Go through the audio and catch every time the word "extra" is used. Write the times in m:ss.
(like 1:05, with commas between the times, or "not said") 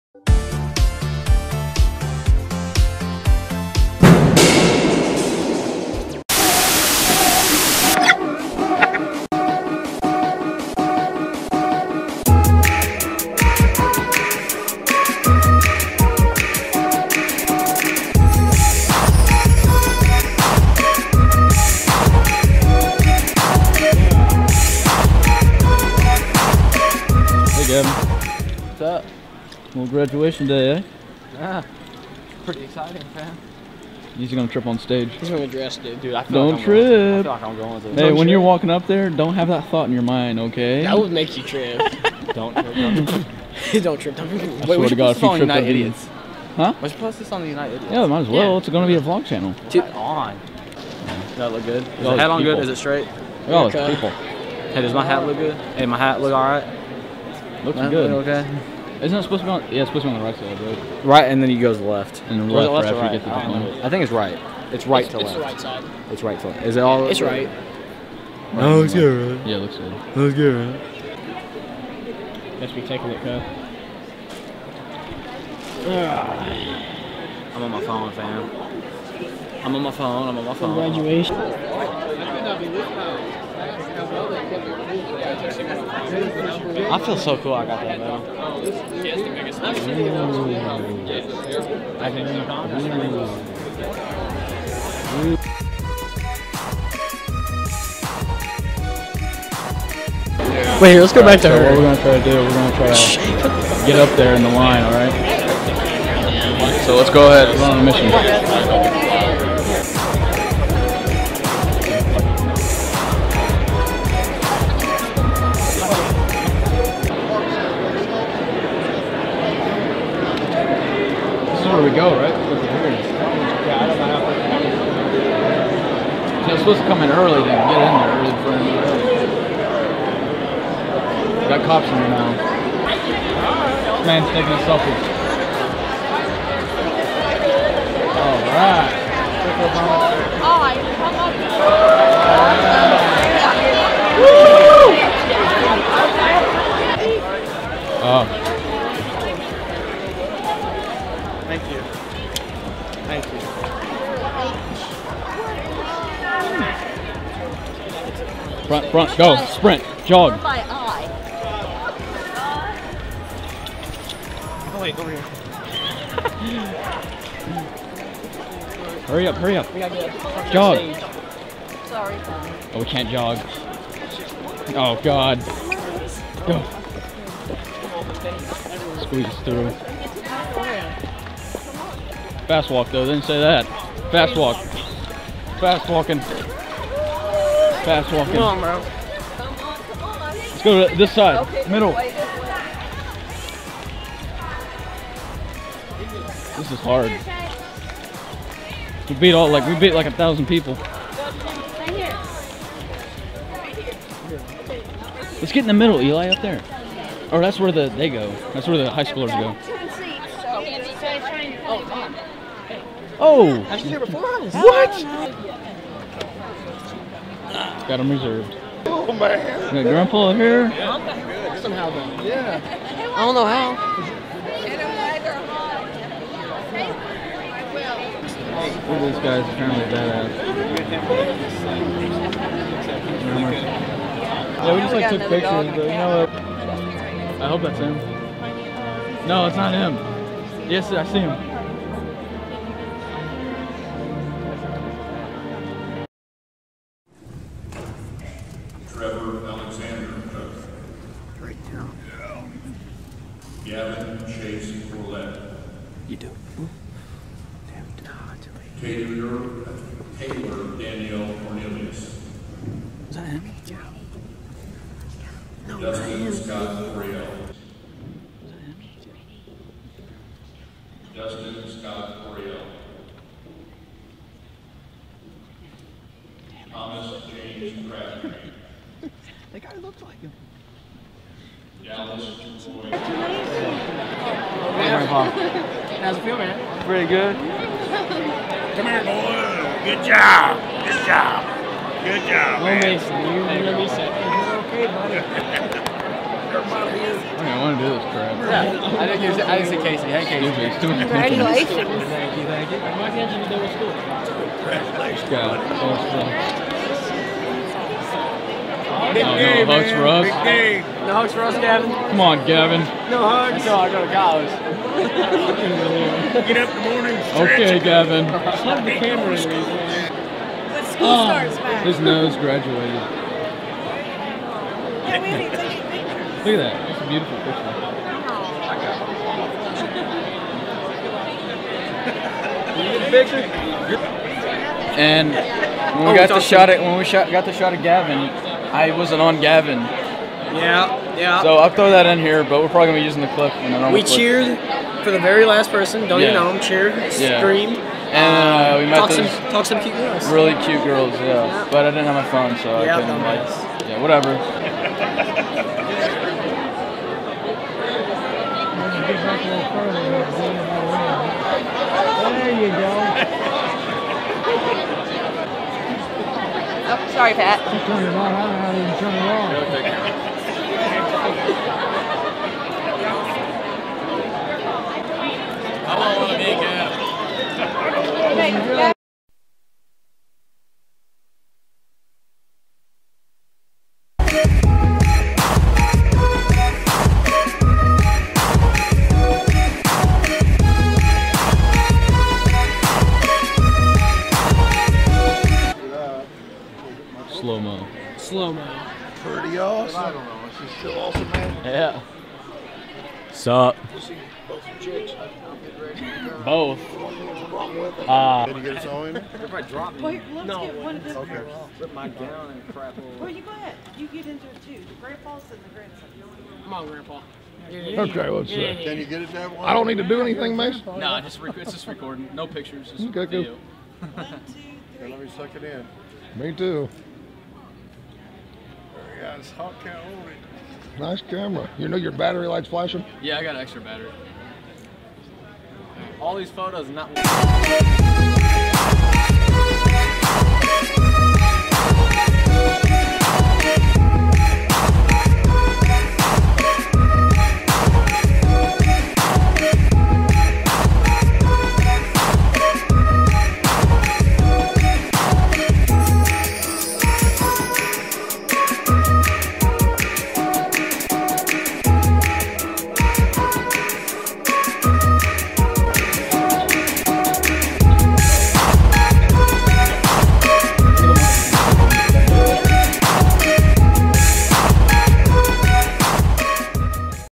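7:13.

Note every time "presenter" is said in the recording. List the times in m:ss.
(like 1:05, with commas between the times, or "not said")
not said.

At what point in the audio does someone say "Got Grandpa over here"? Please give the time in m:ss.
3:39.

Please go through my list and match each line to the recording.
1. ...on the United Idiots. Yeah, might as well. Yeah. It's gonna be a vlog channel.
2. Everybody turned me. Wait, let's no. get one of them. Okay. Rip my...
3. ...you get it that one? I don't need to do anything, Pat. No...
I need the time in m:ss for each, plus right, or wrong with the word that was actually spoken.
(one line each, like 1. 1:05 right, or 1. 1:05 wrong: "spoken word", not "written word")
1. 0:47 right
2. 6:49 wrong: "dropped", not "turned"
3. 6:58 wrong: "Mason", not "Pat".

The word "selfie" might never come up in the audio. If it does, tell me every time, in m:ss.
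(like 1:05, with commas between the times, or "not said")
2:14.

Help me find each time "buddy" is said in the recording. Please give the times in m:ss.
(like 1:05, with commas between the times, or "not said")
4:54, 5:05.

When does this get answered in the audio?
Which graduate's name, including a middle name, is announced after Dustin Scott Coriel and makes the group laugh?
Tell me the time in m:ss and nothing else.
4:36.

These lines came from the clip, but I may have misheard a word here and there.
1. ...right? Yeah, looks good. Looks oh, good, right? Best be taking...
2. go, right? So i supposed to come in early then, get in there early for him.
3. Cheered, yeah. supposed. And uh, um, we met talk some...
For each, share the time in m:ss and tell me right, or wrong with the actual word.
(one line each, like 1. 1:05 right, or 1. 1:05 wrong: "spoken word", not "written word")
1. 1:09 right
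2. 2:01 right
3. 5:46 wrong: "screamed", not "supposed".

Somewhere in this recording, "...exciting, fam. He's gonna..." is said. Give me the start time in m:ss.
0:32.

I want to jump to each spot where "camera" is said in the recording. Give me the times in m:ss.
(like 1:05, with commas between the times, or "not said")
5:18, 7:11.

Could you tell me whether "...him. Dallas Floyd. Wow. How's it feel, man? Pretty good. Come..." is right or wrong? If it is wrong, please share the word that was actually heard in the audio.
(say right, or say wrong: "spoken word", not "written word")
right.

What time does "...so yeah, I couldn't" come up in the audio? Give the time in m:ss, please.
5:52.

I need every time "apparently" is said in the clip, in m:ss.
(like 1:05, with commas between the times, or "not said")
3:49.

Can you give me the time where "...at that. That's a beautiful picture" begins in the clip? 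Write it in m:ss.
5:26.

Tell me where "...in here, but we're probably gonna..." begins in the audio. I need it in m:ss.
5:42.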